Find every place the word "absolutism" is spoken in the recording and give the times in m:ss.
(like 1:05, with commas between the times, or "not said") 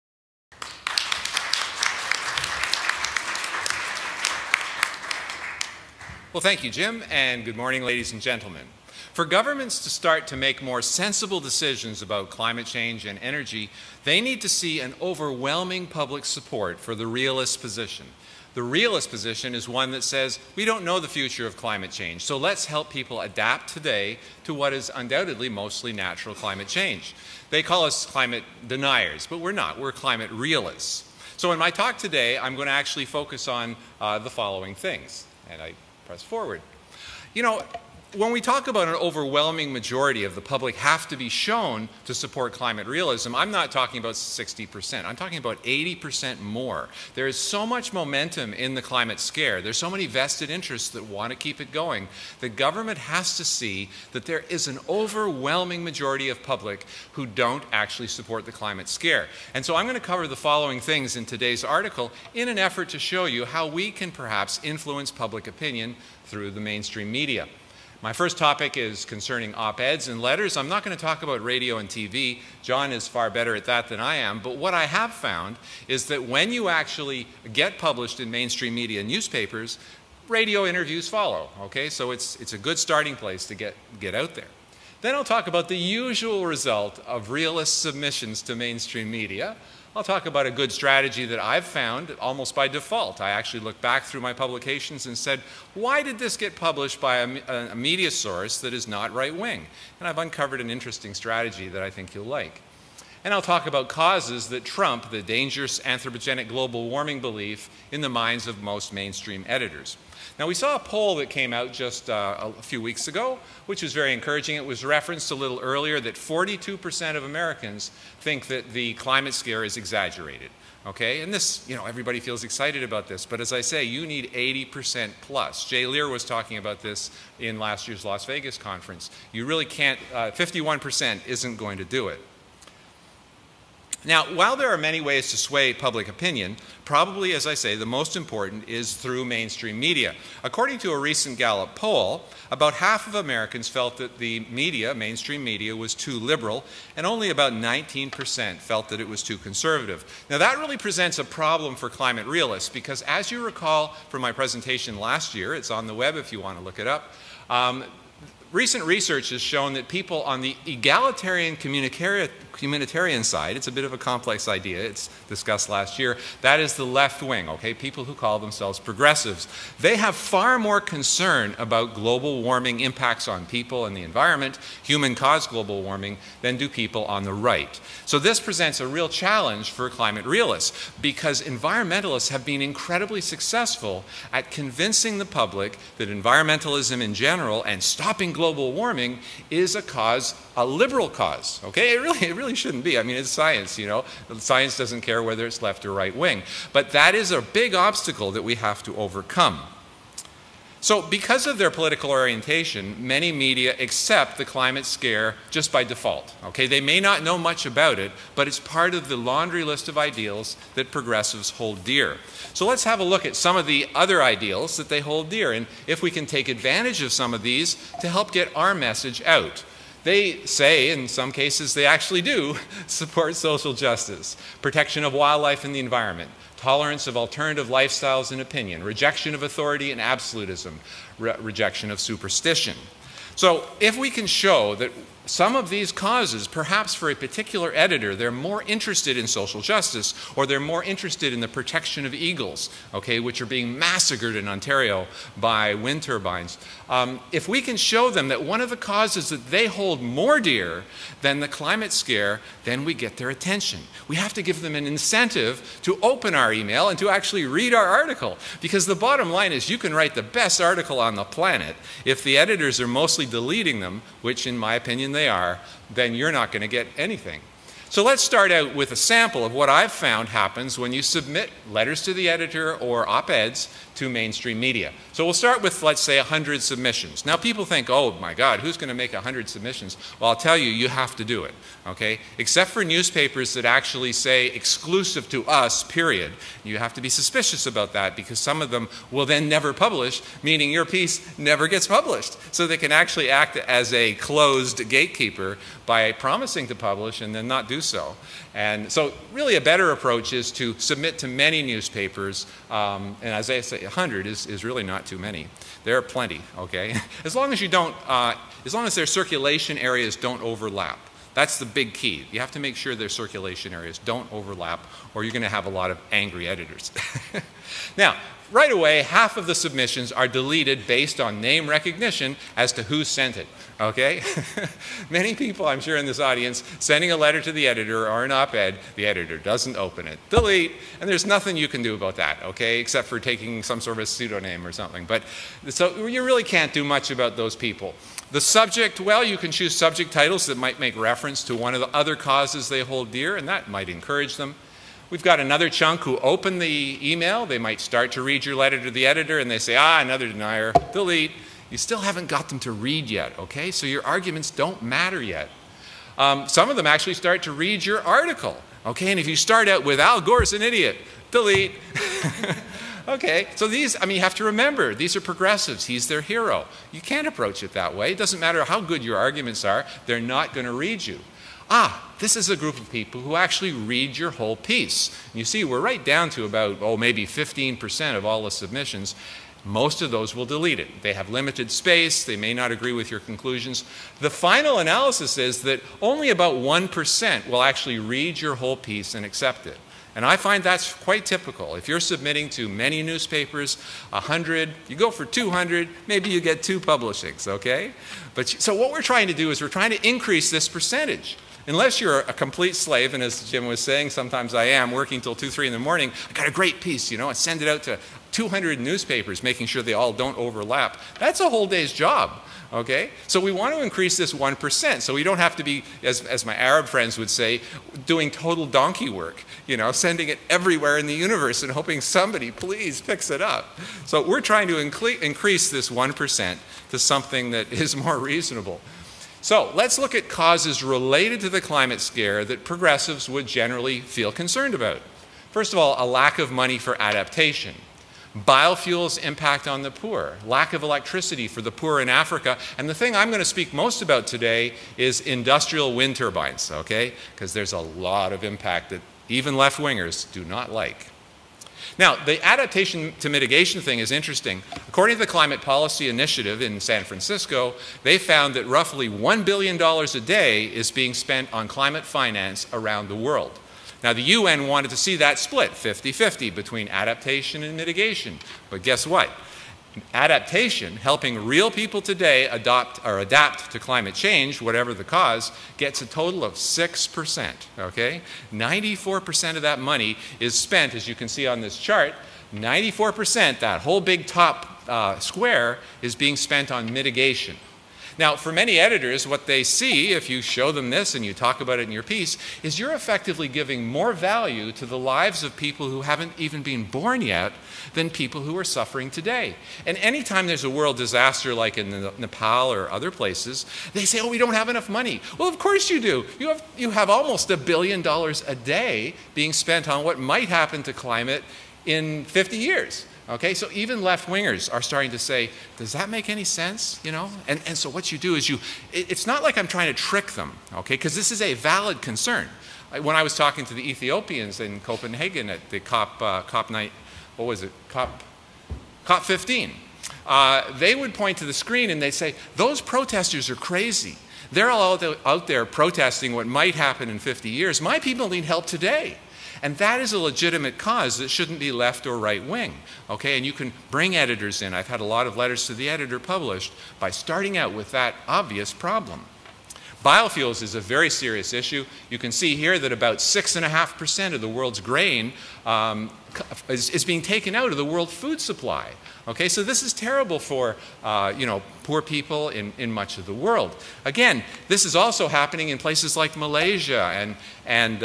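3:50.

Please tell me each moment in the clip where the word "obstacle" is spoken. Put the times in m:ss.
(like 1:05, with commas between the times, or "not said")
3:17.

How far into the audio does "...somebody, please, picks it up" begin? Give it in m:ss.
7:01.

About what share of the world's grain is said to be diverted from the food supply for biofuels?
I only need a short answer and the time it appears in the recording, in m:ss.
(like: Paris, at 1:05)
6.5%, at 9:13.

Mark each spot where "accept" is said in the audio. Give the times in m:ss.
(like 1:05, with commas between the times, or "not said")
3:23, 6:29.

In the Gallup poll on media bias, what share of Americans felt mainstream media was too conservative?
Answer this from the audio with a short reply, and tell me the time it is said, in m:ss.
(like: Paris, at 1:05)
19%, at 2:27.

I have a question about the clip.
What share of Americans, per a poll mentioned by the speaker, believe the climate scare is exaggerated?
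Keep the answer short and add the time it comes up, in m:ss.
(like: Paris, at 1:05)
42%, at 1:56.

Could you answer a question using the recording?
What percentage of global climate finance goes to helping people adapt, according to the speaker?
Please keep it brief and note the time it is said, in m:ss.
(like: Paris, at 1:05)
6%, at 7:56.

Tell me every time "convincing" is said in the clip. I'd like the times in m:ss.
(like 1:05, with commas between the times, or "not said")
3:04.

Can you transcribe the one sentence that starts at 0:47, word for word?
There is so much momentum in the climate scare.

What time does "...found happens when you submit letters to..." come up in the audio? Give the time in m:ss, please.
4:29.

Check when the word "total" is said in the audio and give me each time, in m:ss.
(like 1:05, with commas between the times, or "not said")
6:58, 7:56.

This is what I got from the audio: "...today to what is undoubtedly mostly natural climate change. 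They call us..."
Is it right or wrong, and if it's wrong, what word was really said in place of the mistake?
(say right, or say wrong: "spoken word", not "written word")
right.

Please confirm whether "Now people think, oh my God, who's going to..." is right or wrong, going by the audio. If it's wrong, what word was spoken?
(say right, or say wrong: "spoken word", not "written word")
right.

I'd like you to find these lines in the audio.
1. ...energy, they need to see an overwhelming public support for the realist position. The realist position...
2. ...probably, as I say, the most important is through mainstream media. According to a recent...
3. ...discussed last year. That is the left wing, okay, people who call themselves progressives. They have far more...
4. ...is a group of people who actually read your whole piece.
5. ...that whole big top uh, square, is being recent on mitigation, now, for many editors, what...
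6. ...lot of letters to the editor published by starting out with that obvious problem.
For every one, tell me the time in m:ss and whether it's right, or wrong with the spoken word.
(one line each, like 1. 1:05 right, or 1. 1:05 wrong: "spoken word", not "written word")
1. 0:13 right
2. 2:16 right
3. 2:45 right
4. 6:12 right
5. 8:03 wrong: "spent", not "recent"
6. 9:05 right.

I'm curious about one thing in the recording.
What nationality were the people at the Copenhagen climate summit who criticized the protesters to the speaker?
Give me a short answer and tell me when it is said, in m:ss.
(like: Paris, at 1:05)
Ethiopians, at 8:43.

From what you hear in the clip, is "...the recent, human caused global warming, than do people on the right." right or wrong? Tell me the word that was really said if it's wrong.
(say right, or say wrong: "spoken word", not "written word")
wrong: "environment", not "recent".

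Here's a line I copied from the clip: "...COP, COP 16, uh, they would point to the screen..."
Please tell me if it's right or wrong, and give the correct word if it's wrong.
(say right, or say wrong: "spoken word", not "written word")
wrong: "15", not "16".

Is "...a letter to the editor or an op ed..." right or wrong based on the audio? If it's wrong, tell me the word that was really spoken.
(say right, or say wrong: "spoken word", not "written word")
right.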